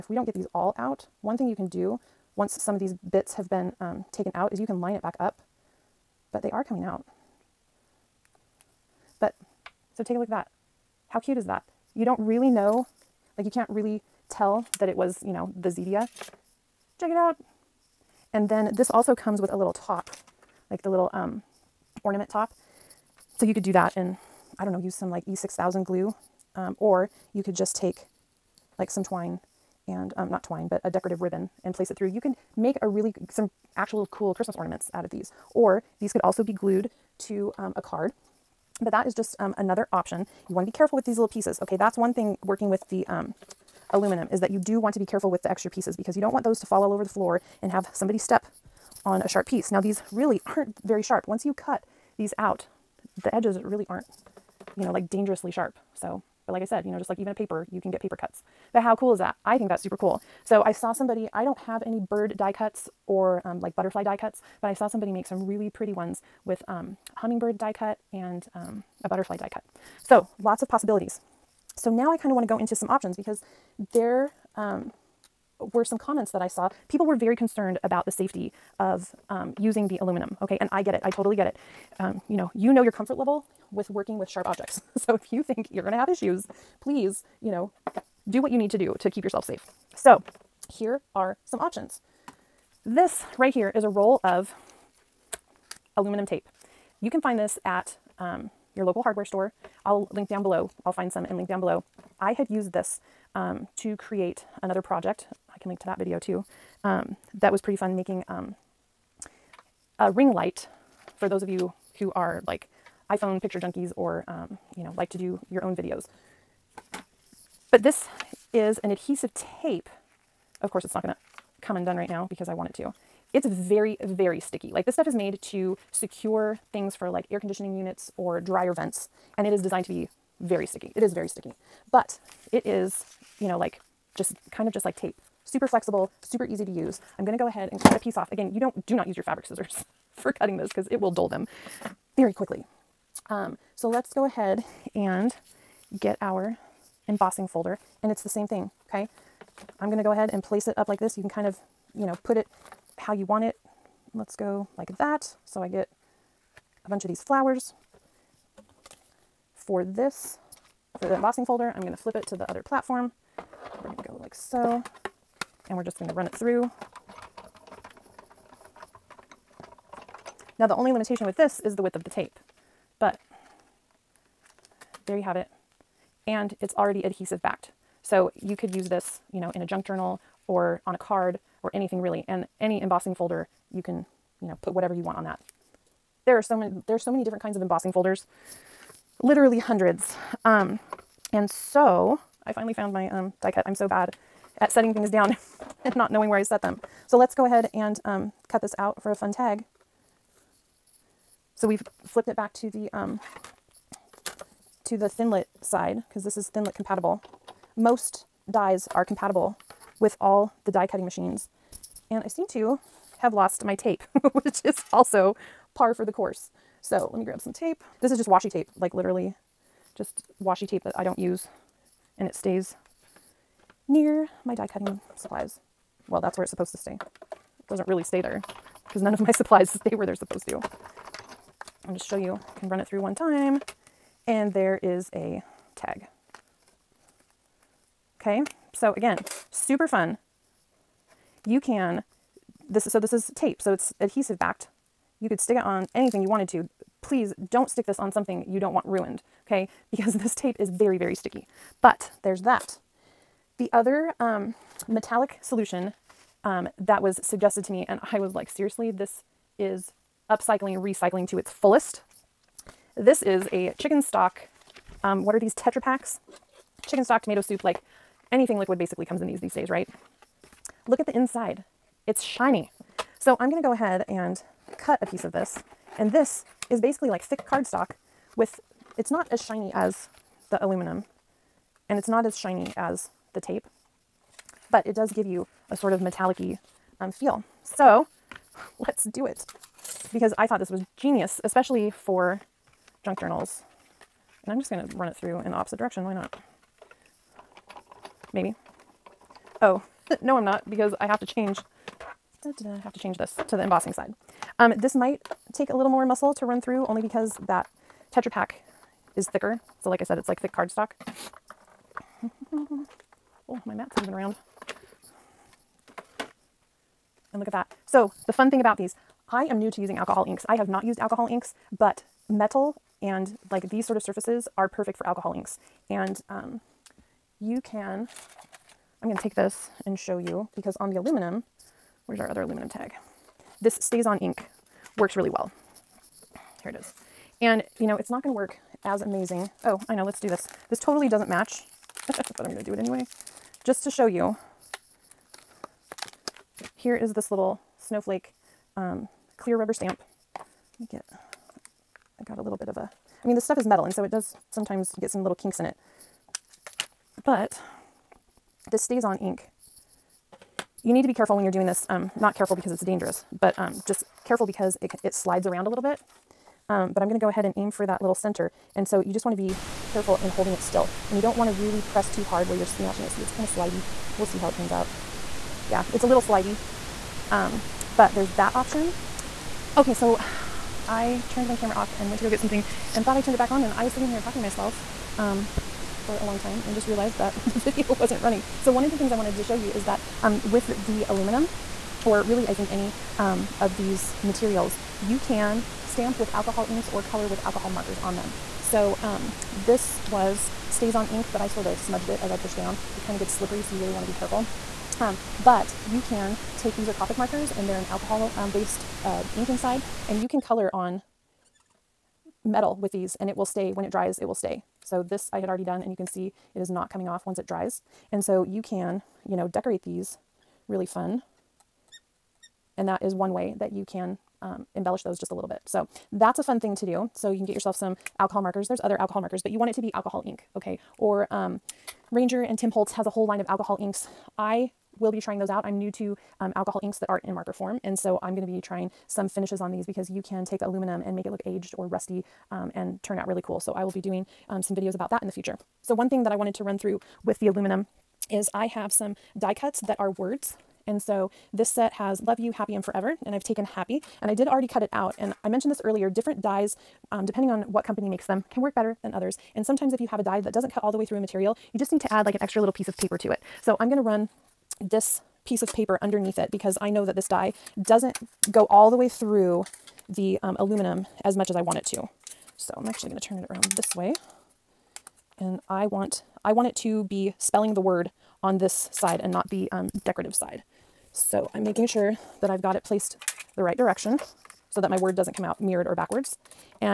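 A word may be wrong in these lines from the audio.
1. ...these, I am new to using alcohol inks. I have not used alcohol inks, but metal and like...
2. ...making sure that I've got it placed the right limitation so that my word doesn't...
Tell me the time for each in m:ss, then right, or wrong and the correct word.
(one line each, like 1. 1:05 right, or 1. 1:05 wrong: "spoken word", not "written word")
1. 5:18 right
2. 8:01 wrong: "direction", not "limitation".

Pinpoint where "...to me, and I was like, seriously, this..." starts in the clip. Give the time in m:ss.
4:17.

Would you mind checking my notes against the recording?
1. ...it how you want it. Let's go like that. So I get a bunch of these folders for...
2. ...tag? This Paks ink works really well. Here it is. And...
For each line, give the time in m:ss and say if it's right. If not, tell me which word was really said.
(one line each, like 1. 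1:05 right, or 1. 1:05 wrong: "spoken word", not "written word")
1. 2:32 wrong: "flowers", not "folders"
2. 5:32 wrong: "StazOn", not "Paks".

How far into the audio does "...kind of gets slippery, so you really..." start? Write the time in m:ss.
6:43.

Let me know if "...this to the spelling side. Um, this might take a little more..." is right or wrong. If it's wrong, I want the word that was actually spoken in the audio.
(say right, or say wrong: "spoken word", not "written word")
wrong: "embossing", not "spelling".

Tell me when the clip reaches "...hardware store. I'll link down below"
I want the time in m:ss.
1:39.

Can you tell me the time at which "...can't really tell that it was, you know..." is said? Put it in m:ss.
0:13.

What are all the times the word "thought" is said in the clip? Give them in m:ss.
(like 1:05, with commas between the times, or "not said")
4:50, 6:23.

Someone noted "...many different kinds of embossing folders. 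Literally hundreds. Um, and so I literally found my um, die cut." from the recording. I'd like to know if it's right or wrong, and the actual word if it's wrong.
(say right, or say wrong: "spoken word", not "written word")
wrong: "finally", not "literally".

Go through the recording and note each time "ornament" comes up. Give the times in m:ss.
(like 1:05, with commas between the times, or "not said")
0:22, 0:34.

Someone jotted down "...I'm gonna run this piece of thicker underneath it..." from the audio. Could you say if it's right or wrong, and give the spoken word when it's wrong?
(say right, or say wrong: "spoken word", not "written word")
wrong: "paper", not "thicker".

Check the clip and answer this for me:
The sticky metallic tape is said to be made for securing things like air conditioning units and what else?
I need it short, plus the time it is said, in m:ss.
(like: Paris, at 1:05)
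Dryer vents, at 2:08.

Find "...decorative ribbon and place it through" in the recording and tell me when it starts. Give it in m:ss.
0:30.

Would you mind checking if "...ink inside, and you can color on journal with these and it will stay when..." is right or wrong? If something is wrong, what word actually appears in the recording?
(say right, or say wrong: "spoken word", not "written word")
wrong: "metal", not "journal".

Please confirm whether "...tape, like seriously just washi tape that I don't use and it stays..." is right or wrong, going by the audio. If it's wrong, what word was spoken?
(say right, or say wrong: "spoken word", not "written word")
wrong: "literally", not "seriously".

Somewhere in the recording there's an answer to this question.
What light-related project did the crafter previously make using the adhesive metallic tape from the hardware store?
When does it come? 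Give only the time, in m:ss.
1:49.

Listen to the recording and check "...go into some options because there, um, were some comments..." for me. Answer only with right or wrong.
right.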